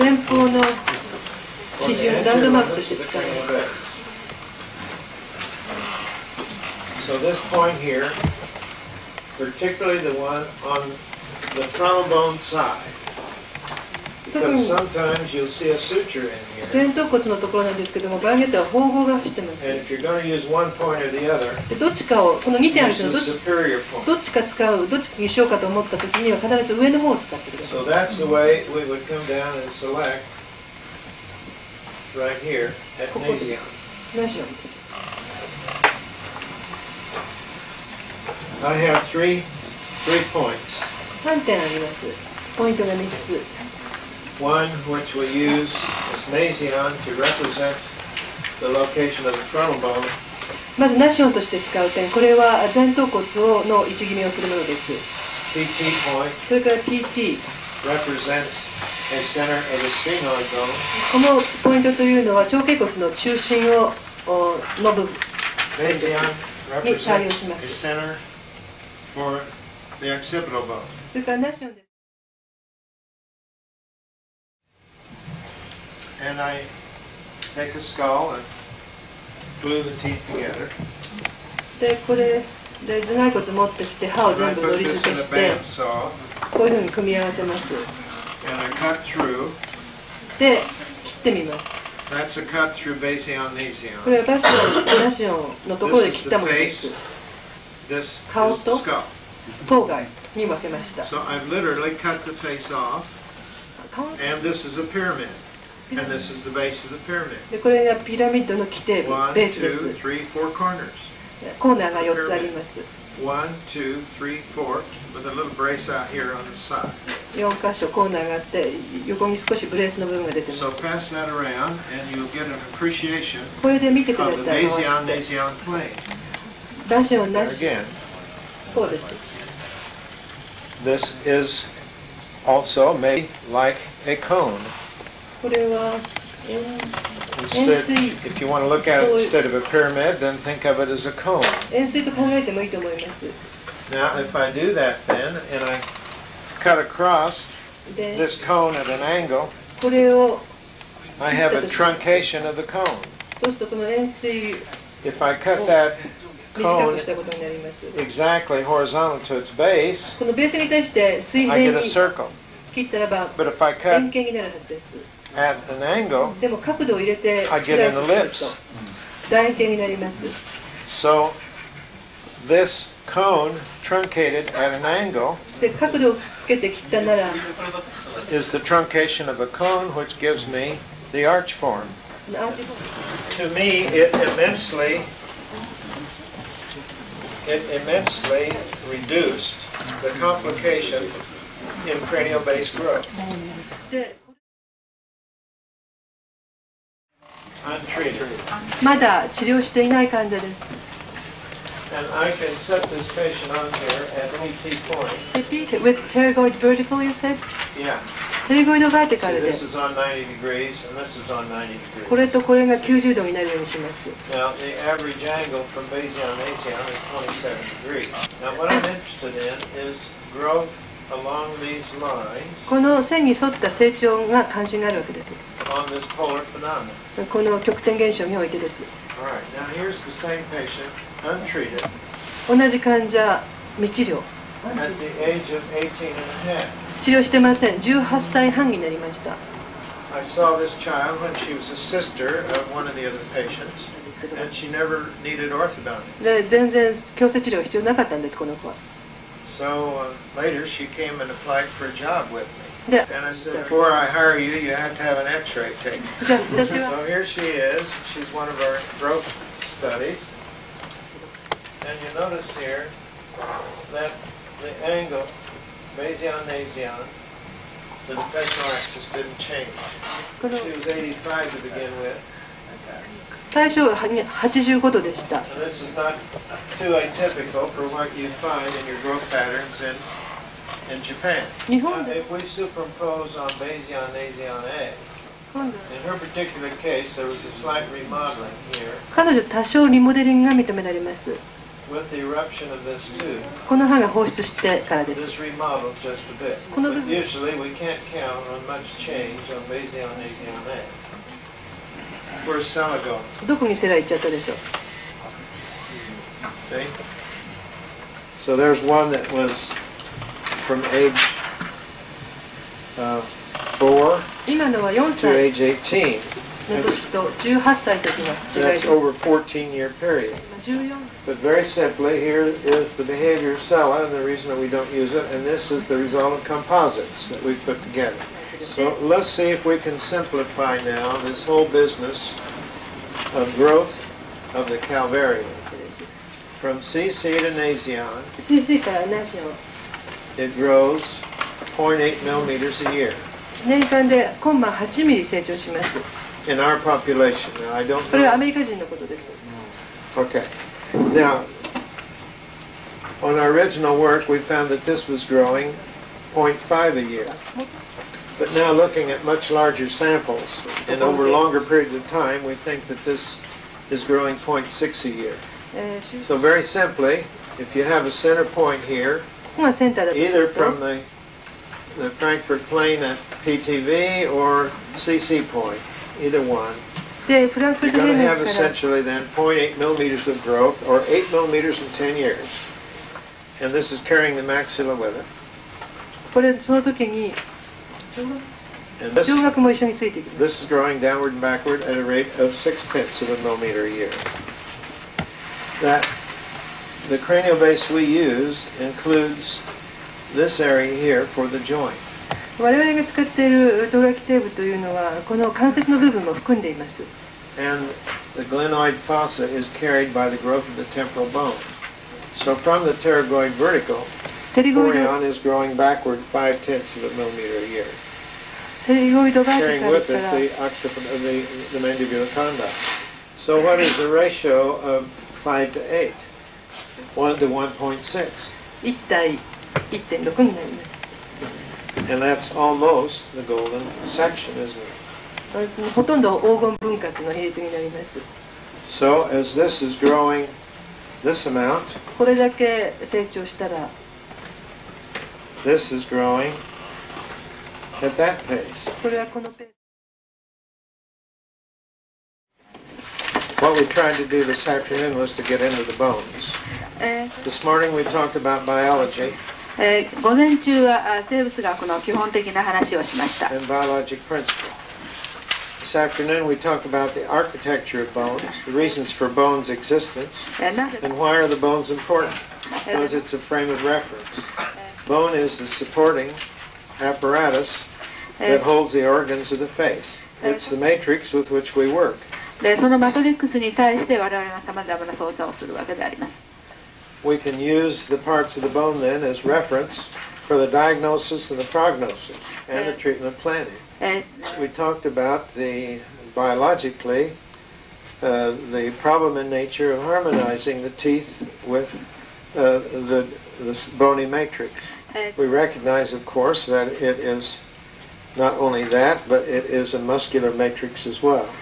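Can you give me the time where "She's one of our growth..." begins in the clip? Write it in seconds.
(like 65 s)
258 s.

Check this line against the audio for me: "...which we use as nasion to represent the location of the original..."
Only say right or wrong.
wrong.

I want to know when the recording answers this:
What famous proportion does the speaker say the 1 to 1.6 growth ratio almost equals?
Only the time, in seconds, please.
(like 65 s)
433 s.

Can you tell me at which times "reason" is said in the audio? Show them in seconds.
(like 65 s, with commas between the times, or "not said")
324 s, 468 s.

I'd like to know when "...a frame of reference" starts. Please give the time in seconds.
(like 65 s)
473 s.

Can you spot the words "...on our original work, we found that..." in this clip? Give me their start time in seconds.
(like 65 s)
353 s.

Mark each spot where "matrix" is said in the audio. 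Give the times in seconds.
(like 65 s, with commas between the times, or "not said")
480 s, 504 s, 510 s.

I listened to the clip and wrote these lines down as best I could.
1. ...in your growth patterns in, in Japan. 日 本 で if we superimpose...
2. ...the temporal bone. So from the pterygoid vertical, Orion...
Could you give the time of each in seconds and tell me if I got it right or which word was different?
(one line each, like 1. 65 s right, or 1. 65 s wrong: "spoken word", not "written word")
1. 278 s right
2. 410 s right.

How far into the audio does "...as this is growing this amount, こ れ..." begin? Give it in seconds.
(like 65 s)
439 s.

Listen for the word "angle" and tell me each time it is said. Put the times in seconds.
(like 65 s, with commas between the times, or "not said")
148 s, 165 s, 174 s, 264 s.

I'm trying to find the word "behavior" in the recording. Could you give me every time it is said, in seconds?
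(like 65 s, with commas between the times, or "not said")
323 s.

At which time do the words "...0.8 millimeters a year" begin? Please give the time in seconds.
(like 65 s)
341 s.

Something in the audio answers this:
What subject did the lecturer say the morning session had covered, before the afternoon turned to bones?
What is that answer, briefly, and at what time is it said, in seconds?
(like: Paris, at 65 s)
biology, at 458 s.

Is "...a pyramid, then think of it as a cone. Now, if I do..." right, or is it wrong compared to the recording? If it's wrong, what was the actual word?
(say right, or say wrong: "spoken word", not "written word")
right.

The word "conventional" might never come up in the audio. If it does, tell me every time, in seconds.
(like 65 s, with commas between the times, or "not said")
268 s.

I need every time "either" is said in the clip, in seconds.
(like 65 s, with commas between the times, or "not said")
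369 s, 376 s.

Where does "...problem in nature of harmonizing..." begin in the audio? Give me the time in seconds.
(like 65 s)
498 s.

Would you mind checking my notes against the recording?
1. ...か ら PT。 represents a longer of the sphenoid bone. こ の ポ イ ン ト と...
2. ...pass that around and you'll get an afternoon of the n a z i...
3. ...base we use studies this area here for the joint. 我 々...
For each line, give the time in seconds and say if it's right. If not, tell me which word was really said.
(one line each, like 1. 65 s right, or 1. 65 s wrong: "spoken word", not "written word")
1. 56 s wrong: "center", not "longer"
2. 120 s wrong: "appreciation", not "afternoon"
3. 397 s wrong: "includes", not "studies".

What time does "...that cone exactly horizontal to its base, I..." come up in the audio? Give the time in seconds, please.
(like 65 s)
155 s.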